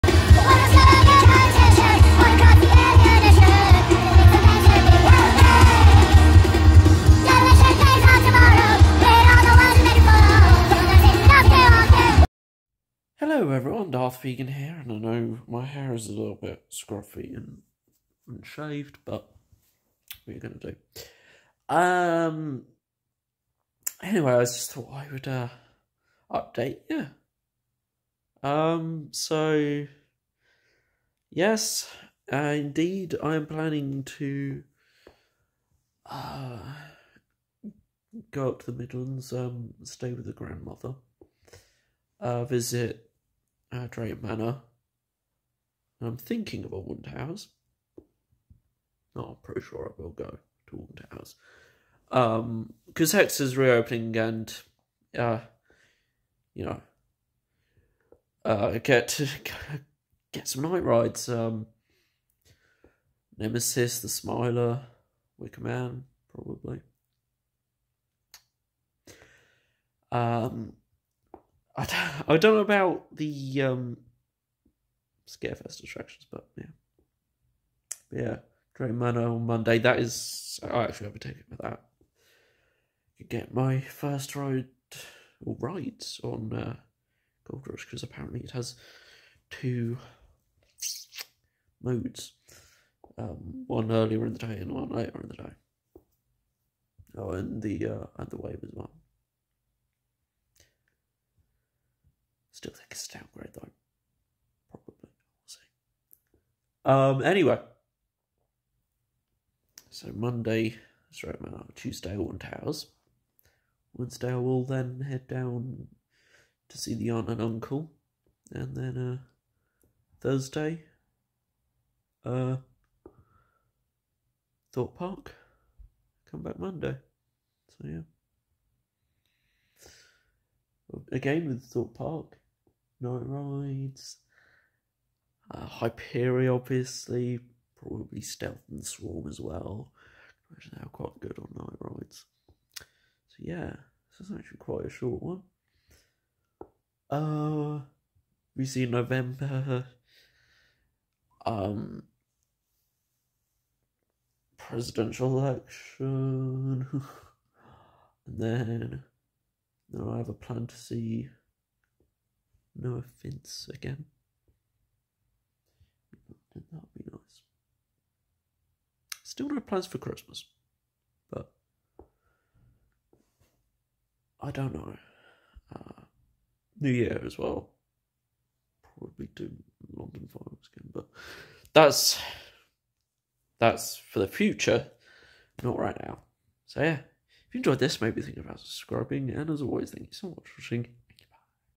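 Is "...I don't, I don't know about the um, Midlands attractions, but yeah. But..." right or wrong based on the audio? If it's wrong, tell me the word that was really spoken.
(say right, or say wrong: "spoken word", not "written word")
wrong: "Scarefest", not "Midlands".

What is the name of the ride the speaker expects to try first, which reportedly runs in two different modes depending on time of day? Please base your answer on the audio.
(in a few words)
Gold Rush.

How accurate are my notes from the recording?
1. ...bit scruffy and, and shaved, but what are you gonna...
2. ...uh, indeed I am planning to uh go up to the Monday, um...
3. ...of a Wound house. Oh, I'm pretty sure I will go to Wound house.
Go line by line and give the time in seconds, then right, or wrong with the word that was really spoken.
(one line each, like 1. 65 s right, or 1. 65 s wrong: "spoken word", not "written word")
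1. 16 s right
2. 32 s wrong: "Midlands", not "Monday"
3. 46 s right.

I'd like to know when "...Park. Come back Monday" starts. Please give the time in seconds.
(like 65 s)
124 s.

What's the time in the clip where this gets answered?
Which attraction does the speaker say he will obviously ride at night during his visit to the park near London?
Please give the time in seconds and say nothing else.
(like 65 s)
135 s.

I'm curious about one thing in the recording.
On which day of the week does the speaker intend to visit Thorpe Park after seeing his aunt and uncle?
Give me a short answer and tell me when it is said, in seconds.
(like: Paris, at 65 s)
Thursday, at 120 s.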